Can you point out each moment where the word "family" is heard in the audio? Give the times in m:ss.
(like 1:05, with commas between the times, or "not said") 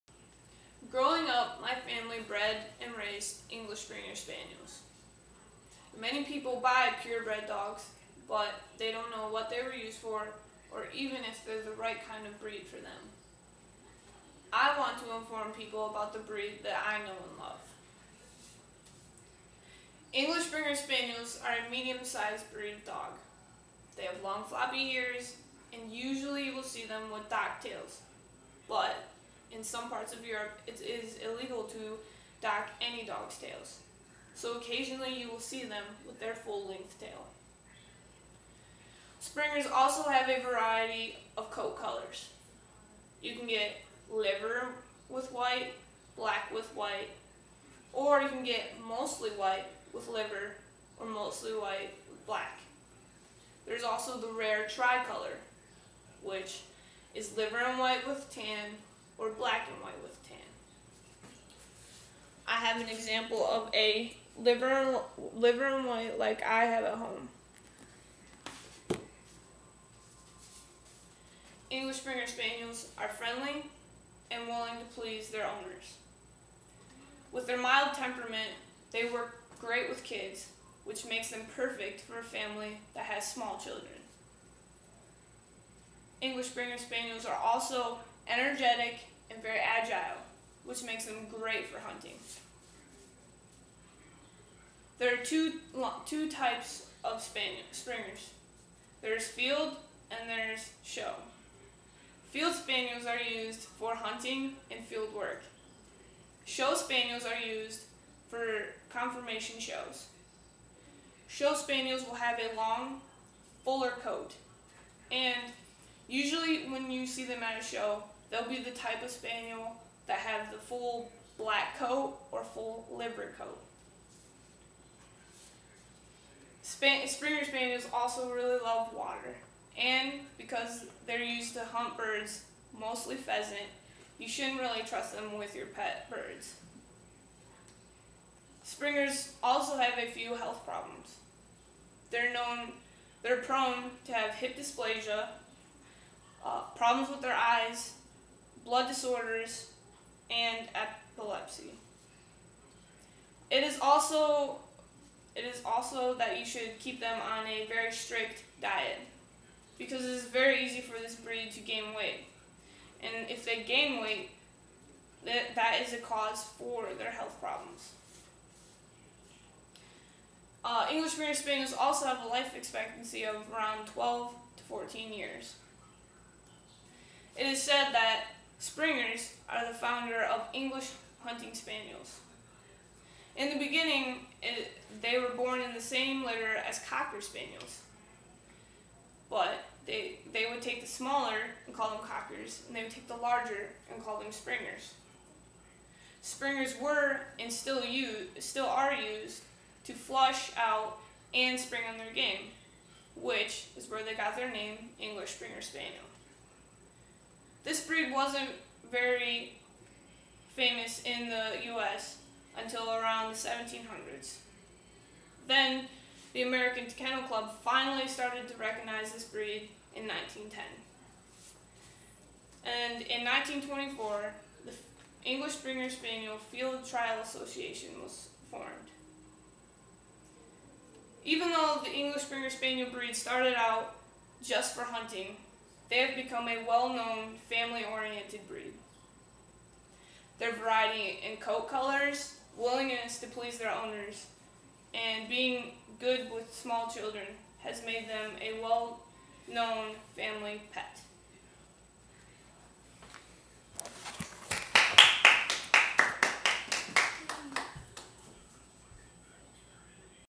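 0:01, 1:22, 3:57, 4:10.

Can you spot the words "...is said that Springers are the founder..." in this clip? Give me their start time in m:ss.
2:57.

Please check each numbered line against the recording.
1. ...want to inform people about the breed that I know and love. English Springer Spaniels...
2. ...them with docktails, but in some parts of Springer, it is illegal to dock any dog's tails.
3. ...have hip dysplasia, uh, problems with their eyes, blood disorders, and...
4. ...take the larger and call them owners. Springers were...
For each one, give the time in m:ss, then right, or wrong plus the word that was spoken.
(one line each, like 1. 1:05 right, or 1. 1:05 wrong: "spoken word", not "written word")
1. 0:14 right
2. 0:26 wrong: "Europe", not "Springer"
3. 2:24 right
4. 3:12 wrong: "springers", not "owners".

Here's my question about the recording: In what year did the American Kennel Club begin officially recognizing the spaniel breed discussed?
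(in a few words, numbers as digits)
1910.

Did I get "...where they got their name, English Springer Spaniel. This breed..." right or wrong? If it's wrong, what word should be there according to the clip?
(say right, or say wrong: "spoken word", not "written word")
right.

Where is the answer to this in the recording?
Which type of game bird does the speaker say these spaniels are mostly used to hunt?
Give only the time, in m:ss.
2:13.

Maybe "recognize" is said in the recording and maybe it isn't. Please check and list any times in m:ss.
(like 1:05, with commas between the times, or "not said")
3:38.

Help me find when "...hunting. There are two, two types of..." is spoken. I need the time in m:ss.
1:31.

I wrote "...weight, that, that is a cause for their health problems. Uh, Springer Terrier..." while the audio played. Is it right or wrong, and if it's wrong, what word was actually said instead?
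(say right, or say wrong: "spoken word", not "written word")
wrong: "English", not "Springer".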